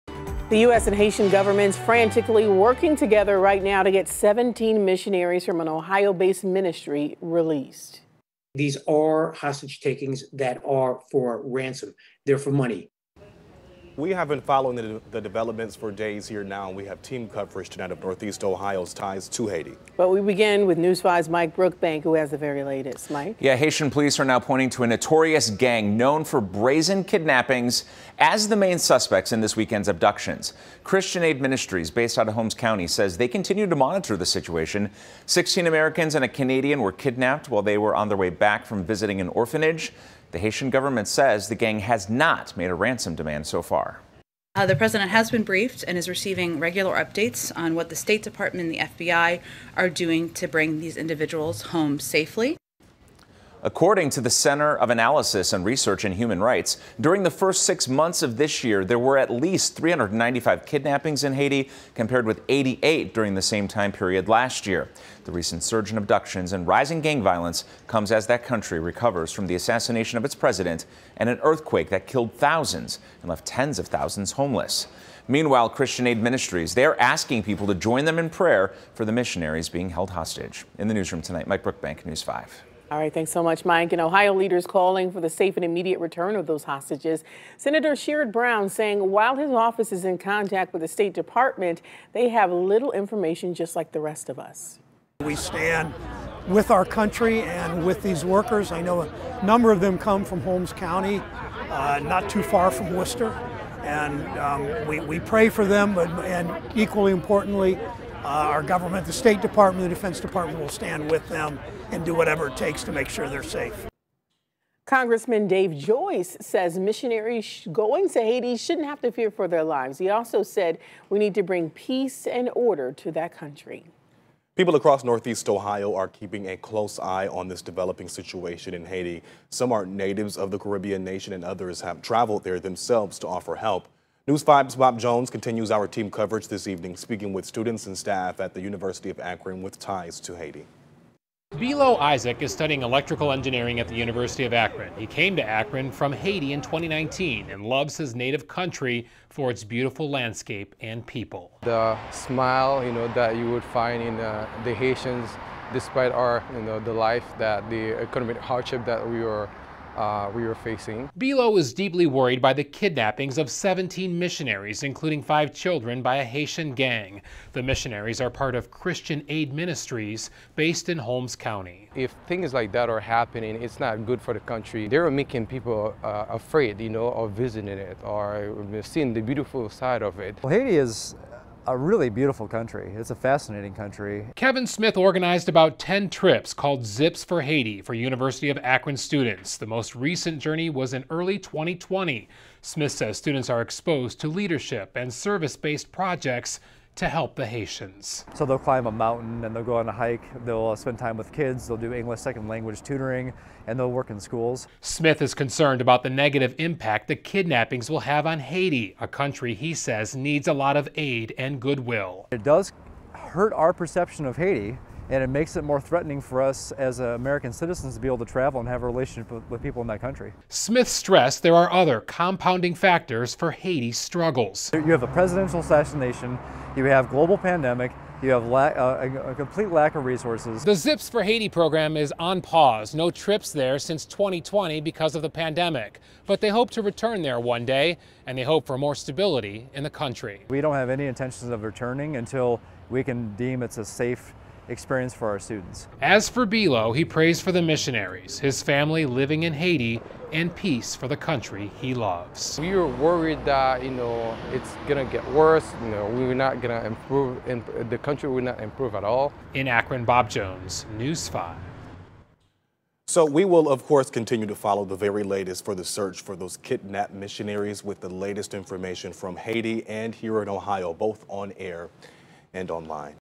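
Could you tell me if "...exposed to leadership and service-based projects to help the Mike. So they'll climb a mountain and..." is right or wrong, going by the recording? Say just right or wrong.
wrong.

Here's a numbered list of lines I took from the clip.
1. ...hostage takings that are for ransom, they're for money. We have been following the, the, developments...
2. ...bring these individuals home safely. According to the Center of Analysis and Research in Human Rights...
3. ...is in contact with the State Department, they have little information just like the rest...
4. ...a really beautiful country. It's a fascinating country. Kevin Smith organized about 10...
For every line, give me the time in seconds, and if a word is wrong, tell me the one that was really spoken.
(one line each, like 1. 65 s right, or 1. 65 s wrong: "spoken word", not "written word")
1. 9 s right
2. 50 s right
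3. 89 s right
4. 181 s right.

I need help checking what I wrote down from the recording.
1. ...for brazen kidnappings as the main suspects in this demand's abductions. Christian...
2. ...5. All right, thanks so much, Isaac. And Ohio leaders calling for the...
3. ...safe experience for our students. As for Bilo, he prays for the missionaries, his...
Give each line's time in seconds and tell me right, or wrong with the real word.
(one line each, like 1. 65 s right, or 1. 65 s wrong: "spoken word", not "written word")
1. 26 s wrong: "weekend", not "demand"
2. 82 s wrong: "Mike", not "Isaac"
3. 243 s right.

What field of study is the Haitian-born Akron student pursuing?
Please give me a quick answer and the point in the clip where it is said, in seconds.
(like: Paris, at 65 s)
electrical engineering, at 142 s.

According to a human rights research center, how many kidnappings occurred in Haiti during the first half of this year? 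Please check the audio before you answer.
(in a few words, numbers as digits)
395.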